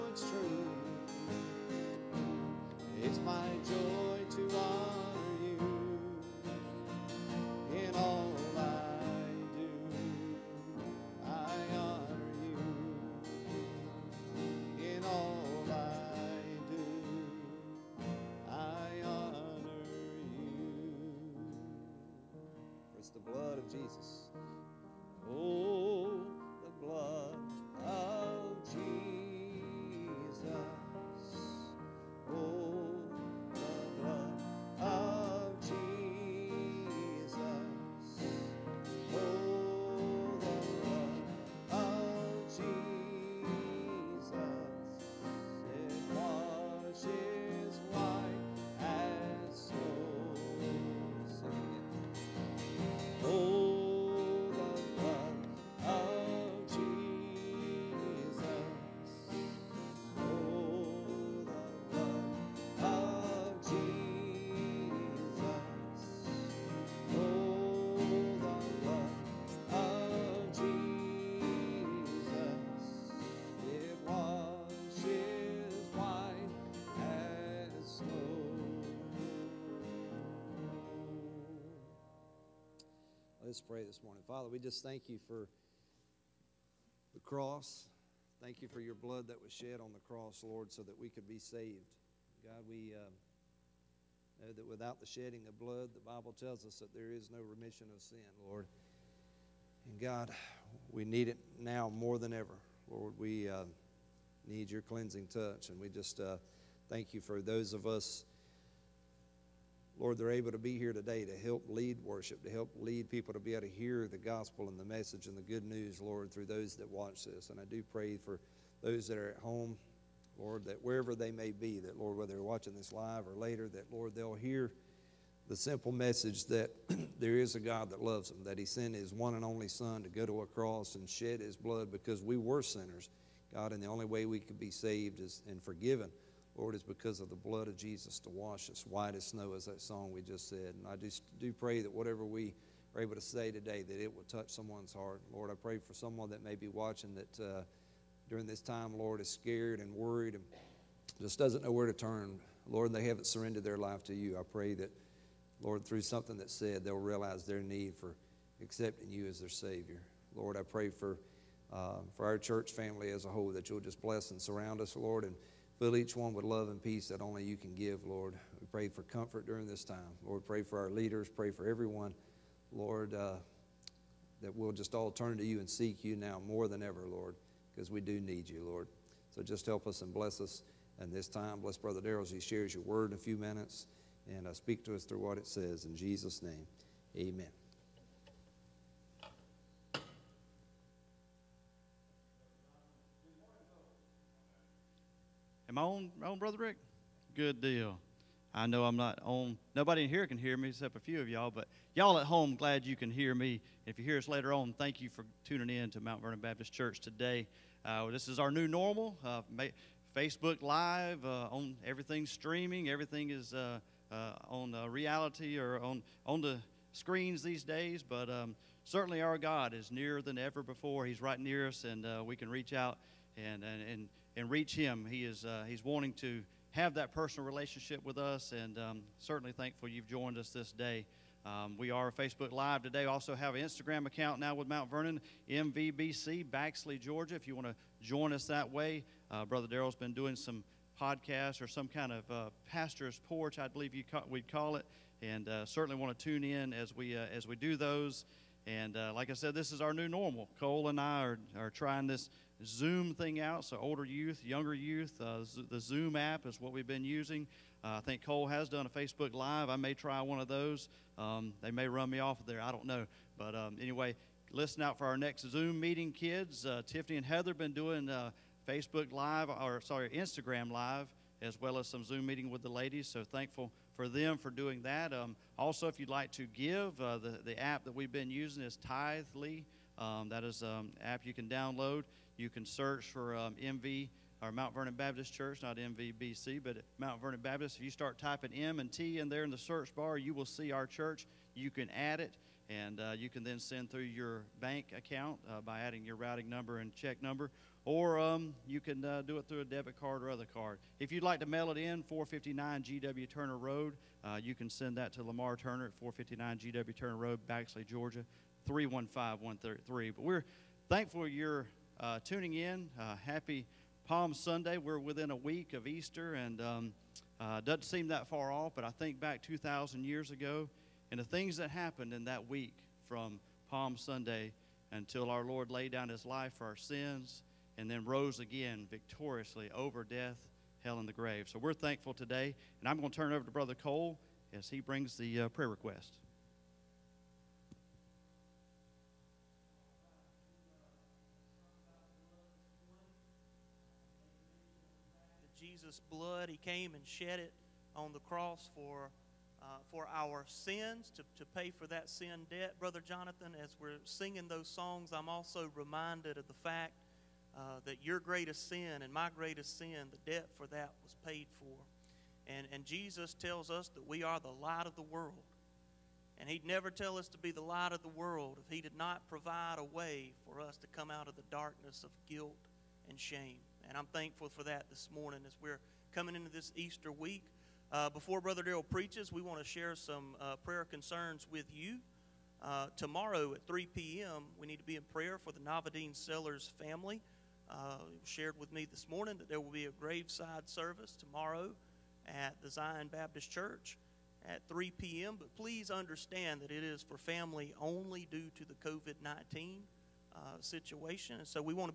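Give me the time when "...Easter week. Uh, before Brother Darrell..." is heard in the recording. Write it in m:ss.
6:16.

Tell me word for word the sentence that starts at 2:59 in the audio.
So just help us and bless us in this time.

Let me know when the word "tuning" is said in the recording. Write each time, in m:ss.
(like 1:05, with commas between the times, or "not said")
3:25, 5:12.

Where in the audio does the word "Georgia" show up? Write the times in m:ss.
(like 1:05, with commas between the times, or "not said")
3:56, 5:07.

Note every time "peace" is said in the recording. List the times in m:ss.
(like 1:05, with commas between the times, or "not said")
2:46.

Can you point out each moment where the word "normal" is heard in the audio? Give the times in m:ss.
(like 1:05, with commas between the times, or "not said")
3:28, 4:10.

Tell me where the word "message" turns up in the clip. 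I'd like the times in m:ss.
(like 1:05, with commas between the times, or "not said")
1:54, 2:05.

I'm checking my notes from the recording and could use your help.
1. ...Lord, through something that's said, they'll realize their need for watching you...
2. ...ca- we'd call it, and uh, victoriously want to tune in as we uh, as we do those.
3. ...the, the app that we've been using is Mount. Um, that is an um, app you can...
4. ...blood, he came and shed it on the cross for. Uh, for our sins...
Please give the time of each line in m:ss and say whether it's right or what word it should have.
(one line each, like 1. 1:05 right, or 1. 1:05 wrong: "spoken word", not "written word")
1. 2:35 wrong: "accepting", not "watching"
2. 4:04 wrong: "certainly", not "victoriously"
3. 4:37 wrong: "Tithely", not "Mount"
4. 5:46 right.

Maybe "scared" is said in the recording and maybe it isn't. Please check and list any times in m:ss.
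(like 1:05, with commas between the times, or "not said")
2:29.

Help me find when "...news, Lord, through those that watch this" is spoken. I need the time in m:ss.
1:55.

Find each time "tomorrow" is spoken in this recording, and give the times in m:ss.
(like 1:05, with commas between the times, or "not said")
6:22, 6:31.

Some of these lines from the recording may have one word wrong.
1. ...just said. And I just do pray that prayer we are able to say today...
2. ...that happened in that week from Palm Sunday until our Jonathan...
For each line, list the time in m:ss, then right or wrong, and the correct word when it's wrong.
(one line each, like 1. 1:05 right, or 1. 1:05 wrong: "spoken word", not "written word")
1. 2:20 wrong: "whatever", not "prayer"
2. 5:21 wrong: "Lord", not "Jonathan".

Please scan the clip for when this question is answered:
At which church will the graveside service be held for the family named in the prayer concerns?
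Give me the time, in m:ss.
6:32.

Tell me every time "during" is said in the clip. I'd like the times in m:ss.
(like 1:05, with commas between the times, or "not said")
2:28, 2:49.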